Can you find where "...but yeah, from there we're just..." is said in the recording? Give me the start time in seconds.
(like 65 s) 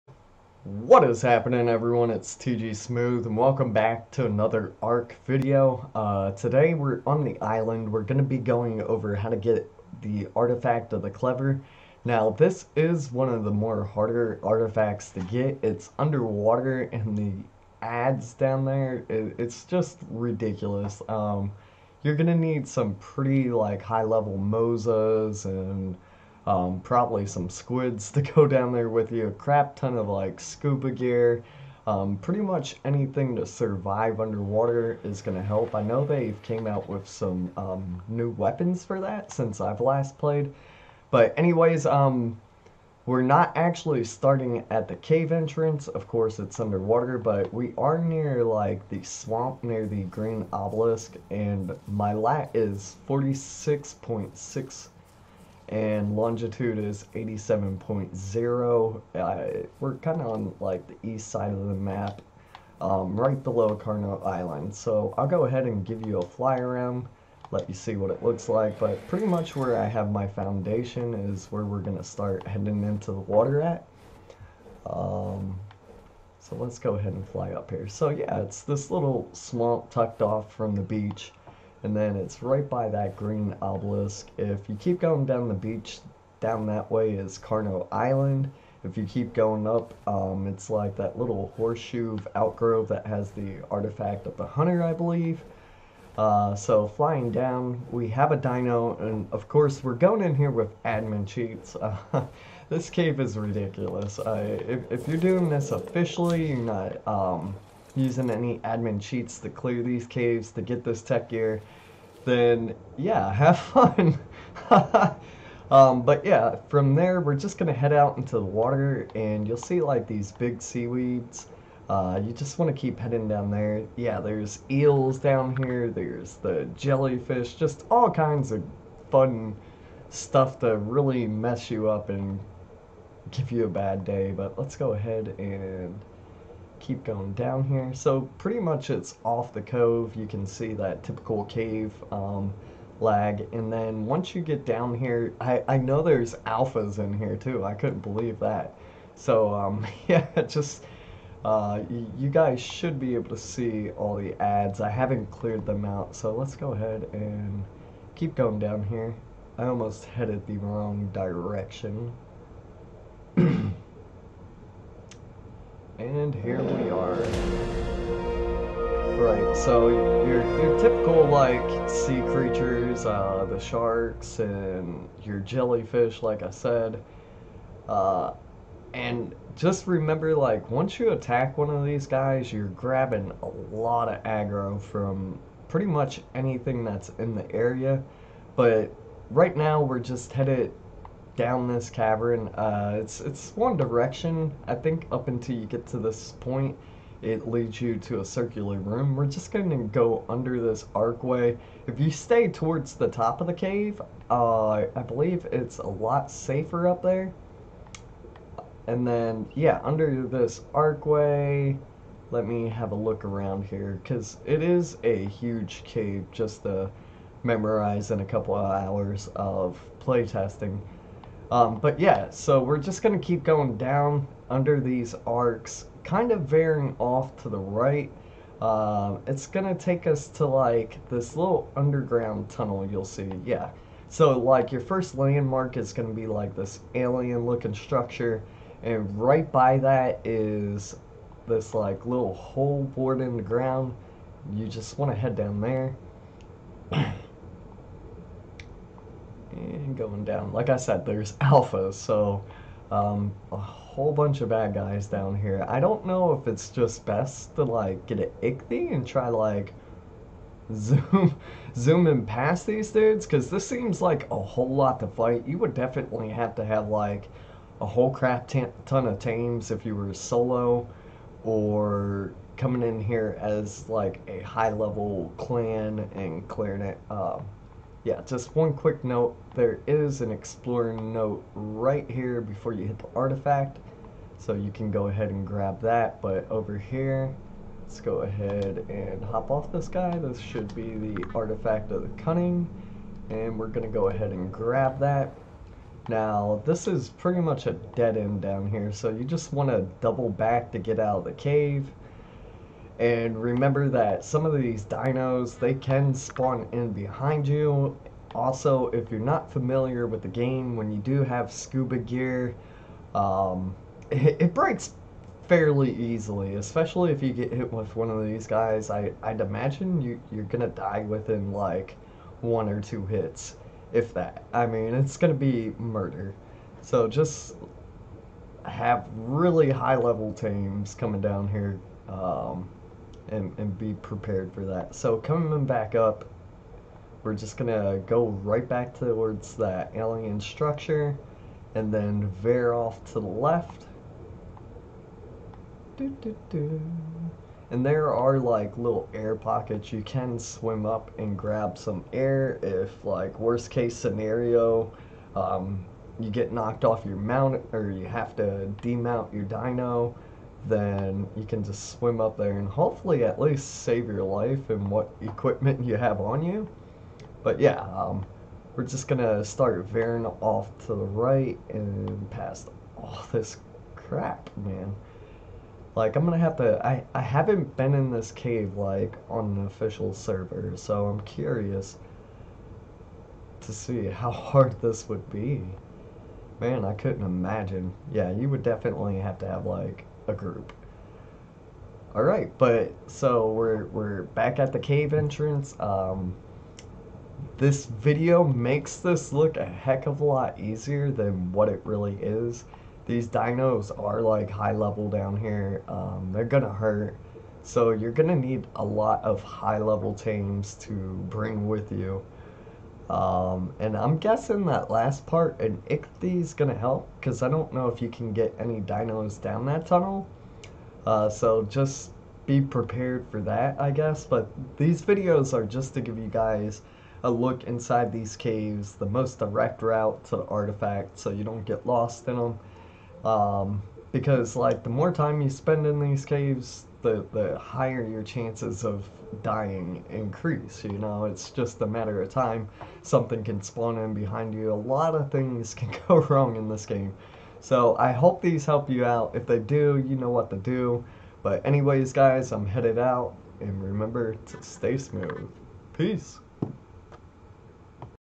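116 s.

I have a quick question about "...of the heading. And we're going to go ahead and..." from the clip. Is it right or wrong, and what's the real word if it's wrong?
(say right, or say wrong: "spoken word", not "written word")
wrong: "cunning", not "heading".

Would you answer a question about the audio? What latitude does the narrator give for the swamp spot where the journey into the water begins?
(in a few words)
46.6.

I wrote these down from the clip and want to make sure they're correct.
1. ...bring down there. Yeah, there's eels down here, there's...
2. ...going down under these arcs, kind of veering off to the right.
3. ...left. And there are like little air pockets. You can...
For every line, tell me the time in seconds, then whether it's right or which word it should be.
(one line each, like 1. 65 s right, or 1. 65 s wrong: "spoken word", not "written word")
1. 122 s wrong: "heading", not "bring"
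2. 223 s right
3. 343 s right.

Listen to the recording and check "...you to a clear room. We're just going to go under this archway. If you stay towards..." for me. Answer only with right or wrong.
wrong.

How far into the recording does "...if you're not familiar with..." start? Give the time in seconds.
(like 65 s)
308 s.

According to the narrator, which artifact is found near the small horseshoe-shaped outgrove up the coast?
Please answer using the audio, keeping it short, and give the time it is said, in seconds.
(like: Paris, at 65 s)
Artifact of the Hunter, at 93 s.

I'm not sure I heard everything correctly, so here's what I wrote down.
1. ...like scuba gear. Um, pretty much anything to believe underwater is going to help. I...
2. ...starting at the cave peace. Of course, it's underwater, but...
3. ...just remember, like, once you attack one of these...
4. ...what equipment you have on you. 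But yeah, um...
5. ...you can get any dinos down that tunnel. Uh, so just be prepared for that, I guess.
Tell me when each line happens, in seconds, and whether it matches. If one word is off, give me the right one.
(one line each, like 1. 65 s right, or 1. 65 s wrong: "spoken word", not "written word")
1. 30 s wrong: "survive", not "believe"
2. 44 s wrong: "entrance", not "peace"
3. 179 s right
4. 364 s right
5. 418 s right.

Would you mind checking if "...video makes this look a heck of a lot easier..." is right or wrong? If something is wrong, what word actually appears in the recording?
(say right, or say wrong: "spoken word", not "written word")
right.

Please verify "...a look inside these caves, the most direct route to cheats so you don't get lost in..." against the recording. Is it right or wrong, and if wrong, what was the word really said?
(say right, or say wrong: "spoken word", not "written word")
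wrong: "artifacts", not "cheats".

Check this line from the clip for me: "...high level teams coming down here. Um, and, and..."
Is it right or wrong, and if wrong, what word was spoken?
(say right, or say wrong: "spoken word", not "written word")
right.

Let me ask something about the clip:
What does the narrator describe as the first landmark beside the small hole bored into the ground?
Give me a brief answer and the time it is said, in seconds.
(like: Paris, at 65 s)
alien looking structure, at 236 s.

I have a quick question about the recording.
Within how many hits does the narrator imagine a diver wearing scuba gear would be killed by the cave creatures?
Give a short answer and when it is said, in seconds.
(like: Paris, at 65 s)
one or two, at 322 s.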